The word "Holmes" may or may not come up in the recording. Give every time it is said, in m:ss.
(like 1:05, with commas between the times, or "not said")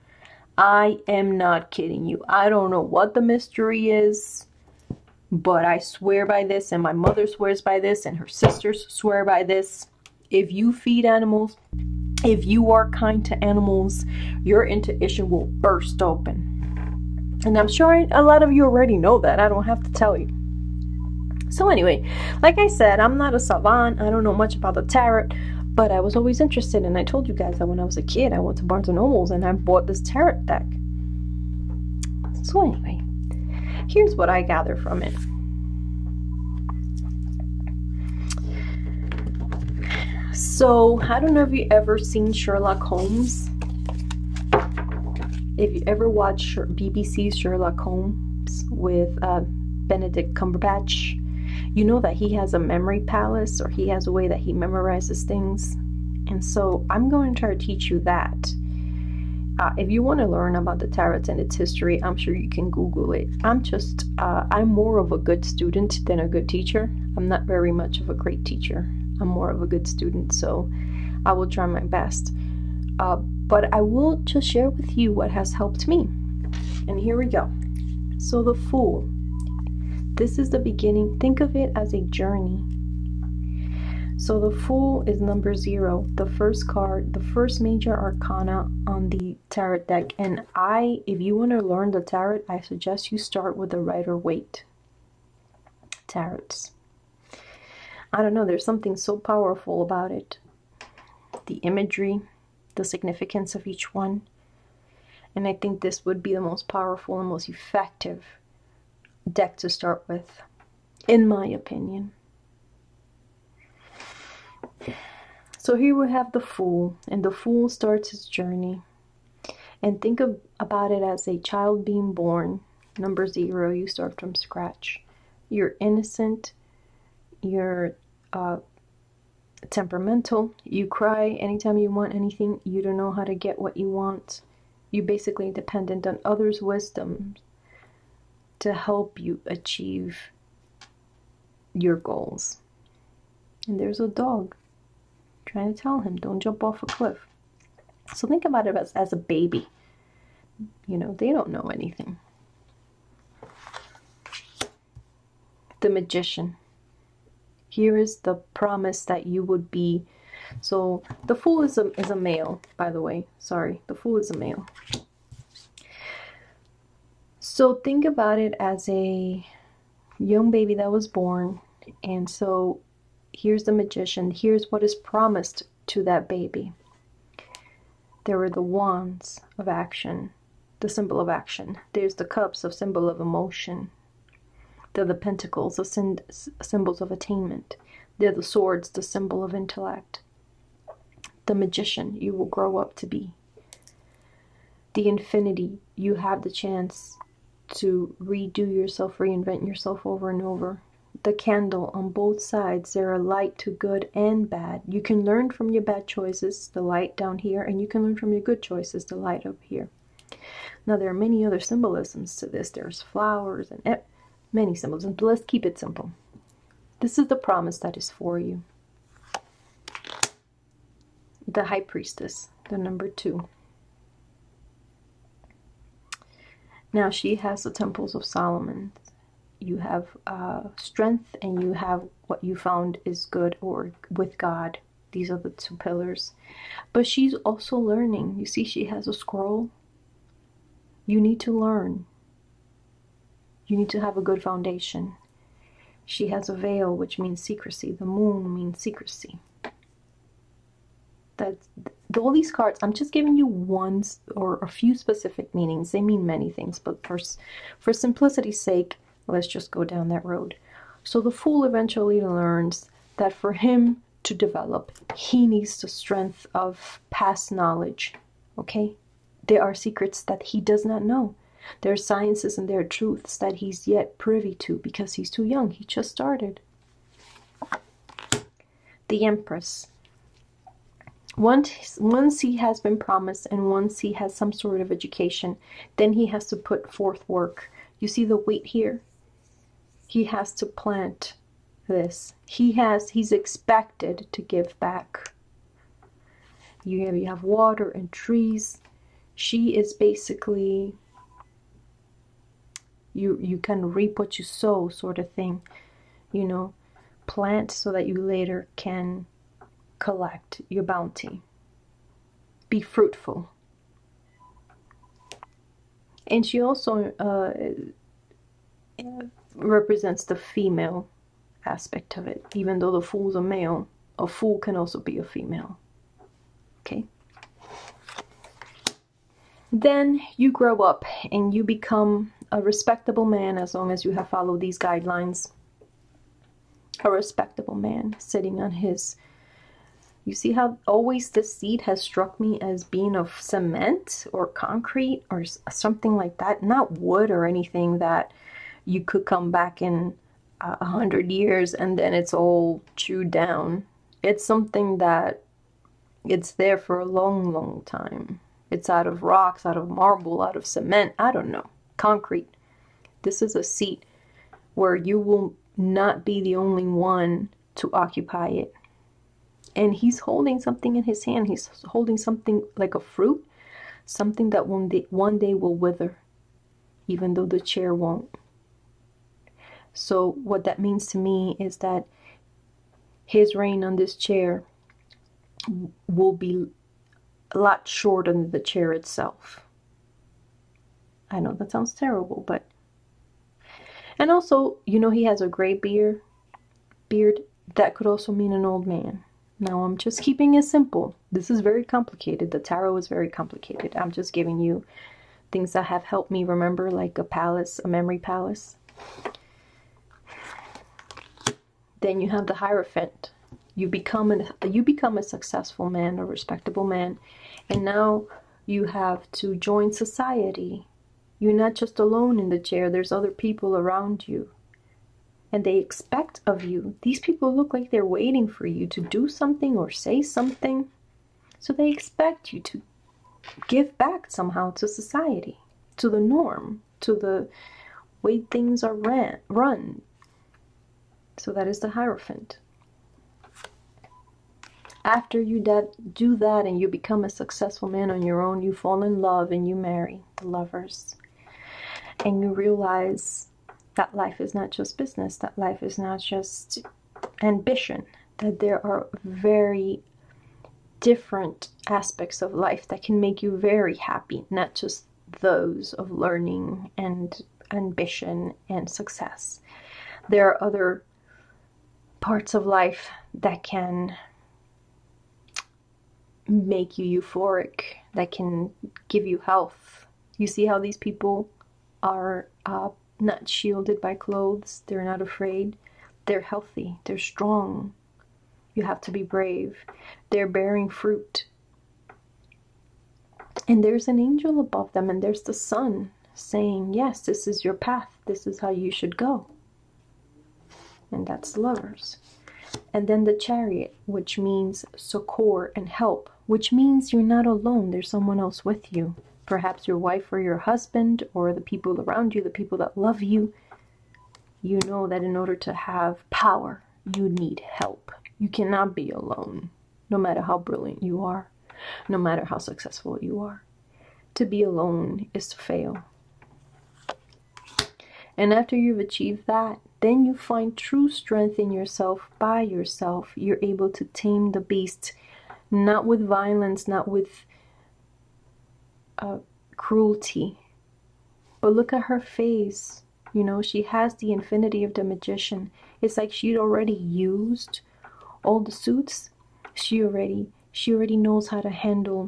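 0:42, 0:47.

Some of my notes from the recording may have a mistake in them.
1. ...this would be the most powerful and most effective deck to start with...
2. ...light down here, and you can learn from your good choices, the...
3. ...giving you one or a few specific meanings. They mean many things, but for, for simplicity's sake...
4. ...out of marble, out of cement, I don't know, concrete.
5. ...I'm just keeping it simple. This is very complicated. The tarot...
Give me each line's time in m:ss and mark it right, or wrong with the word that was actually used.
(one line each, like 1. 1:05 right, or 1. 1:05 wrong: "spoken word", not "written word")
1. 1:45 right
2. 3:26 right
3. 4:13 right
4. 5:59 right
5. 6:39 right.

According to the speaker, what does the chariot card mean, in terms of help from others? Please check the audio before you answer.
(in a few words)
Succor.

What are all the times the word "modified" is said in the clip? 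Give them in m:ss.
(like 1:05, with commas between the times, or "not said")
not said.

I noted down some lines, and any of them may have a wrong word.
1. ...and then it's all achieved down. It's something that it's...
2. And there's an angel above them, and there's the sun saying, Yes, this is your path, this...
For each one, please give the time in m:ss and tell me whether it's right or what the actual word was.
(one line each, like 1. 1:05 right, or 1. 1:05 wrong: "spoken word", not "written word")
1. 5:51 wrong: "chewed", not "achieved"
2. 8:13 right.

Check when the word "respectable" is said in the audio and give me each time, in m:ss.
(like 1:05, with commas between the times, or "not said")
5:32, 5:37, 6:56.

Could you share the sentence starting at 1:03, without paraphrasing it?
I'm just, uh, I'm more of a good student than a good teacher.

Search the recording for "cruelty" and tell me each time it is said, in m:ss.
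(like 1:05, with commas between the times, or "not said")
8:59.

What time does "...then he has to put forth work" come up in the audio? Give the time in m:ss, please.
4:45.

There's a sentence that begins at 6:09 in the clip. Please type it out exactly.
And he's holding something in his hand.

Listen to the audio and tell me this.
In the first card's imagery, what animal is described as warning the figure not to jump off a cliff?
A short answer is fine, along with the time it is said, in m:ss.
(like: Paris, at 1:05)
A dog, at 2:24.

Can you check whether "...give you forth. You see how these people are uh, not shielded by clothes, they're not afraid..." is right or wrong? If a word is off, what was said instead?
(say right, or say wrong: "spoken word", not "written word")
wrong: "health", not "forth".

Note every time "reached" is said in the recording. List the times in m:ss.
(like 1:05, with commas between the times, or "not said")
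not said.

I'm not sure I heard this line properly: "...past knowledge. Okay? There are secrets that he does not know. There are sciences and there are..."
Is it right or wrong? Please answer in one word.
right.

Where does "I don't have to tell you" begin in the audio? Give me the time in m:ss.
0:19.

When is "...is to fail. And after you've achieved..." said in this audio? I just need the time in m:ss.
8:45.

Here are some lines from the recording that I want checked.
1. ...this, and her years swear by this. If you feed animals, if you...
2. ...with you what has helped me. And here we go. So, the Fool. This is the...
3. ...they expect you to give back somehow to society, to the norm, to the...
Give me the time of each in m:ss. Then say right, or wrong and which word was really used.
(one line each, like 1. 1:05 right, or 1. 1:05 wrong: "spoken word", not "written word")
1. 0:07 wrong: "sisters", not "years"
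2. 1:14 right
3. 7:11 right.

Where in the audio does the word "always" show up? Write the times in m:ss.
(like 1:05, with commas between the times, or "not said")
0:26, 5:40.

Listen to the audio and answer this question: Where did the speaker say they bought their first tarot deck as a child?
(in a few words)
Barnes and Noble.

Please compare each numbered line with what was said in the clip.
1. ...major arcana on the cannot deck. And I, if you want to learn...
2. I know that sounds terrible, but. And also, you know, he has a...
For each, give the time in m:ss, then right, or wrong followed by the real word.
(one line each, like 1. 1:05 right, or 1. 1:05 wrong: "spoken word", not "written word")
1. 1:27 wrong: "tarot", not "cannot"
2. 6:31 right.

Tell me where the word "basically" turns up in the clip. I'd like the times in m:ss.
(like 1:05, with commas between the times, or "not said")
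2:15, 4:59.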